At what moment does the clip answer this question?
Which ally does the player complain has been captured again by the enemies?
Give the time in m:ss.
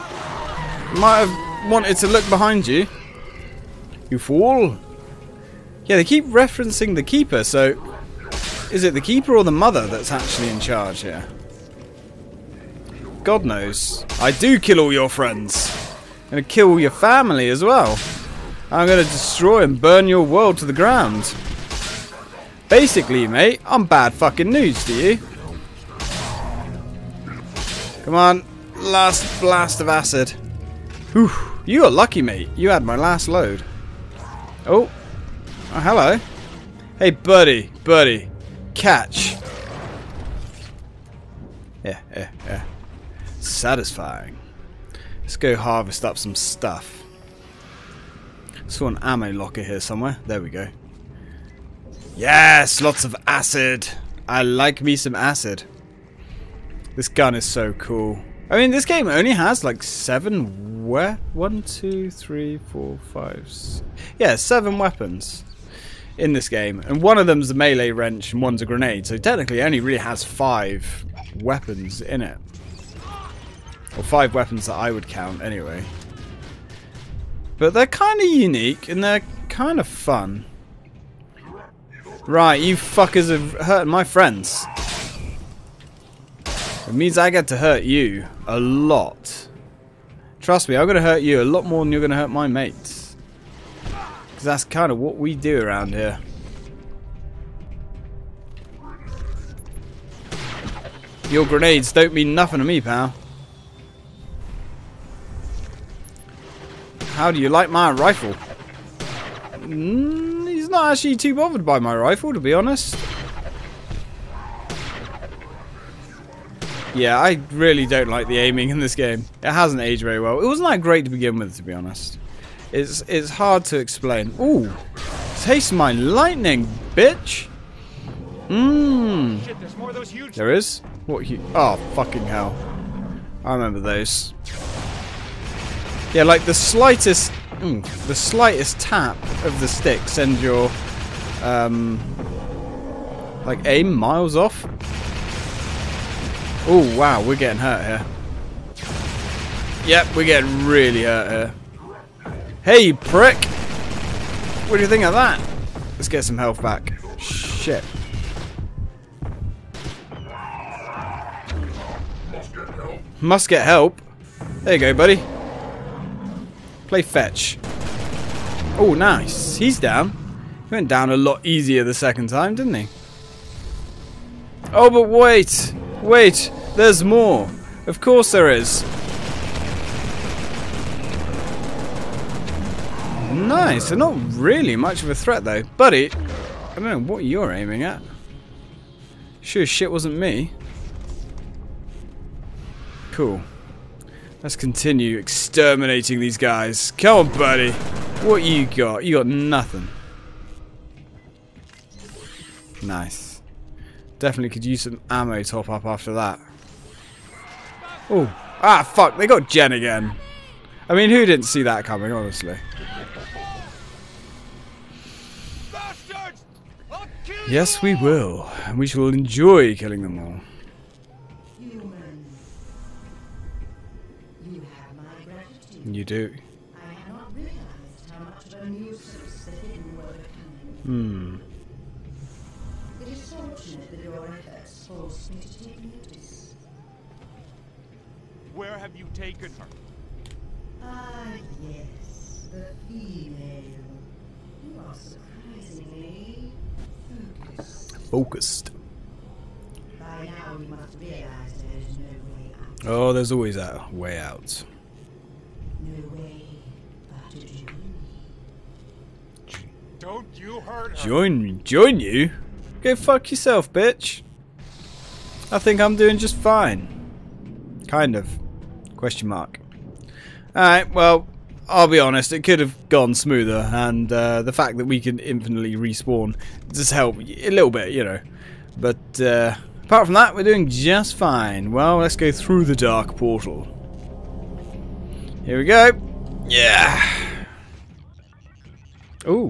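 3:29.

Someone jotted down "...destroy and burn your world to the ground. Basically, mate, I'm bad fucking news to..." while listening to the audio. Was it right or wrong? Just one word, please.
right.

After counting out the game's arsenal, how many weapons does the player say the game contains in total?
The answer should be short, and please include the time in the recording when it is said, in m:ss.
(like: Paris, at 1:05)
7, at 1:04.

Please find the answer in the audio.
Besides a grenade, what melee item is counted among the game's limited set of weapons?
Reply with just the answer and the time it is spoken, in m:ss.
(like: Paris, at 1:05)
wrench, at 1:07.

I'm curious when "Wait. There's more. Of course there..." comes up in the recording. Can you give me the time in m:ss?
2:56.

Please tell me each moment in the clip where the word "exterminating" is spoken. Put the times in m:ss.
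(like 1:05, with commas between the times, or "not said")
3:15.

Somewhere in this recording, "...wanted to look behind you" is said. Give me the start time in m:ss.
0:01.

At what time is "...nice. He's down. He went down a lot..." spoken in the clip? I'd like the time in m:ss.
2:48.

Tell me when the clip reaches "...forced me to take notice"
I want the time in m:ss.
3:54.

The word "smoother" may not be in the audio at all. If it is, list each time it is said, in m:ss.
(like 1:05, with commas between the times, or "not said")
4:33.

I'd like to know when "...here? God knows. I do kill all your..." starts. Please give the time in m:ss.
0:10.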